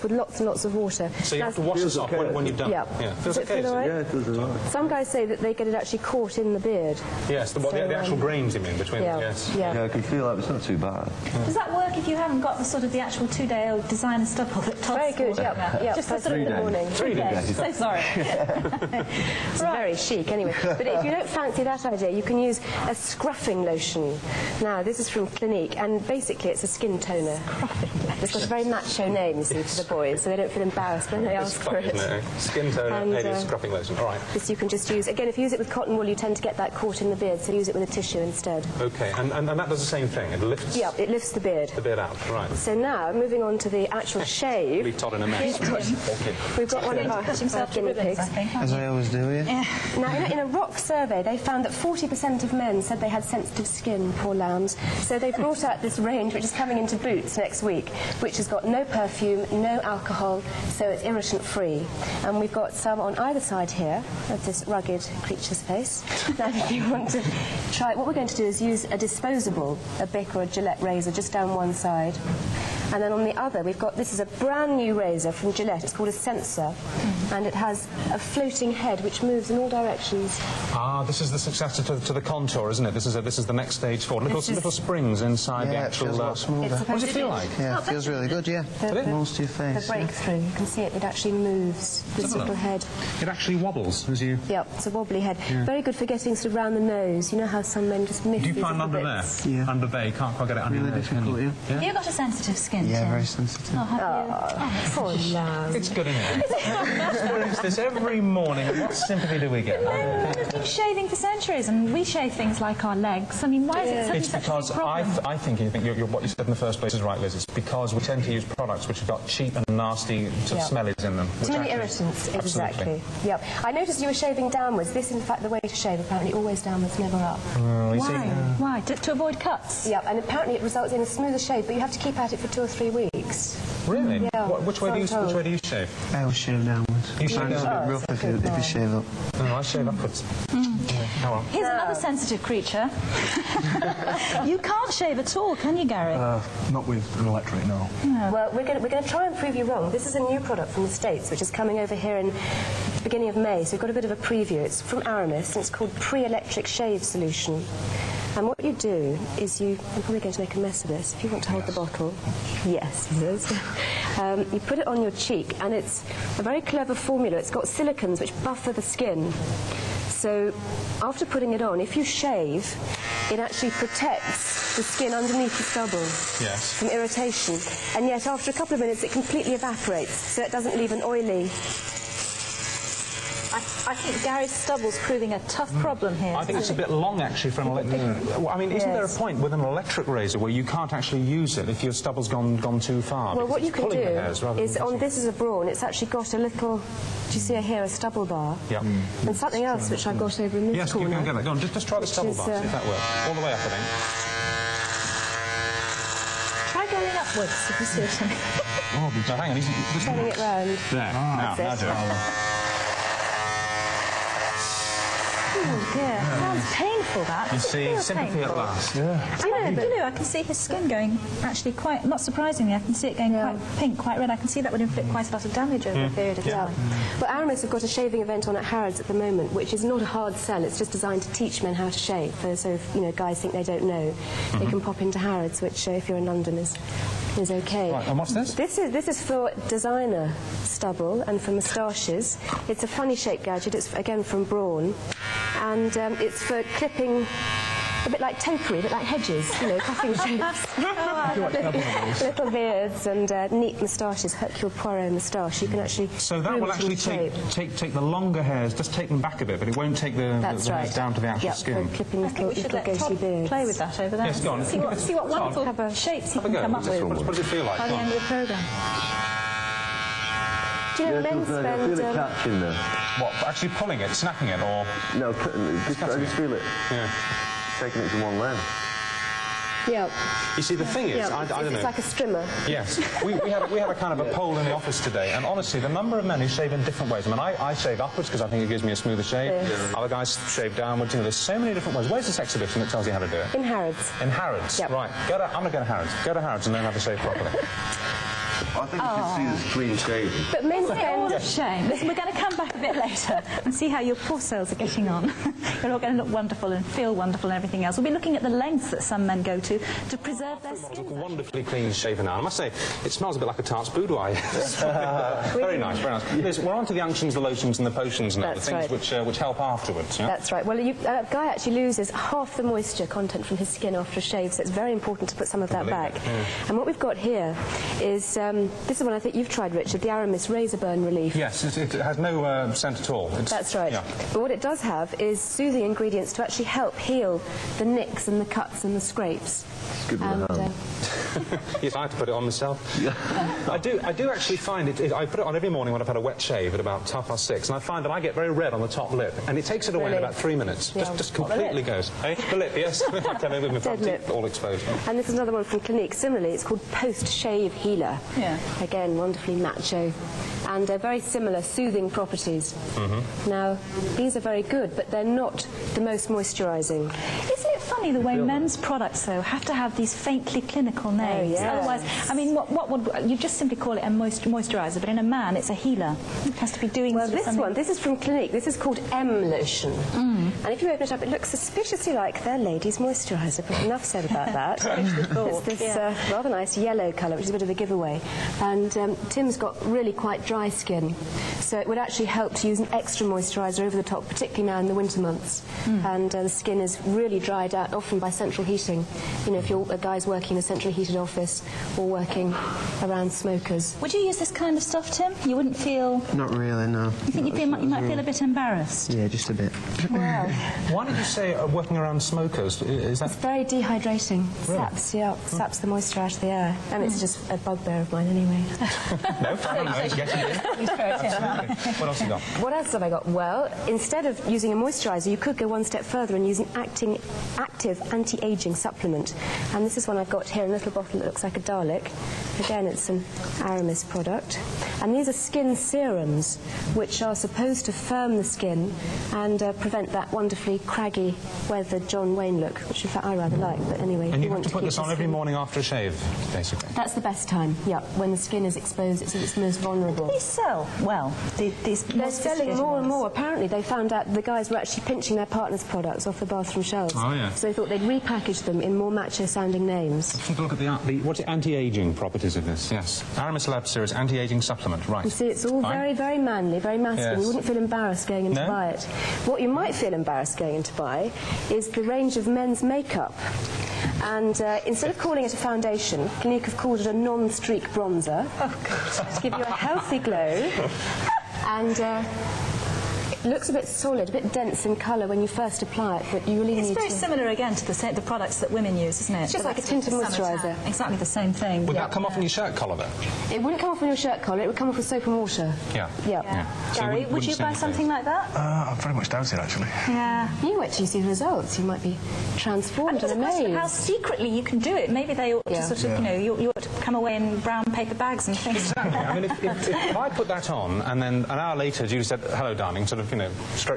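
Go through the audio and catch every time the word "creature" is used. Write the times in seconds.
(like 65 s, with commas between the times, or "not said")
65 s, 142 s.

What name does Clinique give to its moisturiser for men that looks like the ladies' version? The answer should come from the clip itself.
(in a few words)
M Lotion.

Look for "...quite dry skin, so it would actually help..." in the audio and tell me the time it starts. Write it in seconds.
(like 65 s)
390 s.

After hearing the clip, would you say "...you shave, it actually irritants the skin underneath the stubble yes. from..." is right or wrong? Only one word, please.
wrong.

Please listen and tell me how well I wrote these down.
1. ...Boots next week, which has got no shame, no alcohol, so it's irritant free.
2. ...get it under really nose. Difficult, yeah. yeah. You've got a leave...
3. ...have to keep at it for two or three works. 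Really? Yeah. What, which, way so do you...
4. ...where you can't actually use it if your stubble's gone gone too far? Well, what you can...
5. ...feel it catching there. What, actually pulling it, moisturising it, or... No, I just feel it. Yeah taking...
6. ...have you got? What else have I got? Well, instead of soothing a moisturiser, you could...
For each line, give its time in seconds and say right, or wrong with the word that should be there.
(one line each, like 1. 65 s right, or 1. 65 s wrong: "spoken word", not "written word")
1. 56 s wrong: "perfume", not "shame"
2. 100 s wrong: "sensitive", not "leave"
3. 131 s wrong: "weeks", not "works"
4. 190 s right
5. 271 s wrong: "snapping", not "moisturising"
6. 422 s wrong: "using", not "soothing".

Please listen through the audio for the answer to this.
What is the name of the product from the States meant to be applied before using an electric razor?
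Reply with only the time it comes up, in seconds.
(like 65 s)
155 s.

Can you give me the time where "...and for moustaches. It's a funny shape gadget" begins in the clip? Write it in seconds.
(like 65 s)
241 s.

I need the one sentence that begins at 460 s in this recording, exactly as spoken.
Let's take a look at the, the what's it anti-aging properties of this, yes.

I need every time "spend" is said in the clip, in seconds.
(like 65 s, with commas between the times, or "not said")
271 s, 300 s.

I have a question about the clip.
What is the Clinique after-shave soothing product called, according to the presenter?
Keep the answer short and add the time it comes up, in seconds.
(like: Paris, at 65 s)
post-shave healer, at 356 s.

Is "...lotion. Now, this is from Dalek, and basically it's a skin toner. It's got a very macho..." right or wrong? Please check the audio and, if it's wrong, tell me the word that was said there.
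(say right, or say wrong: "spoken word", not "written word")
wrong: "Clinique", not "Dalek".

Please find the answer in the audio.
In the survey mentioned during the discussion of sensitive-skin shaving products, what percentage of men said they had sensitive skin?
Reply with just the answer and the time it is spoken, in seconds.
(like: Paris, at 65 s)
40%, at 51 s.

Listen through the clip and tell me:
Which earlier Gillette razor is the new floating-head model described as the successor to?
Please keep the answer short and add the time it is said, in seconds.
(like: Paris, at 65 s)
Contour, at 82 s.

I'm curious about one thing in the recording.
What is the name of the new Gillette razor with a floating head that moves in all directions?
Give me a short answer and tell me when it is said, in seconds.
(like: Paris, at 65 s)
Sensor, at 76 s.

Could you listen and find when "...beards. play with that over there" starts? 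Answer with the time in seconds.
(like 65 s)
263 s.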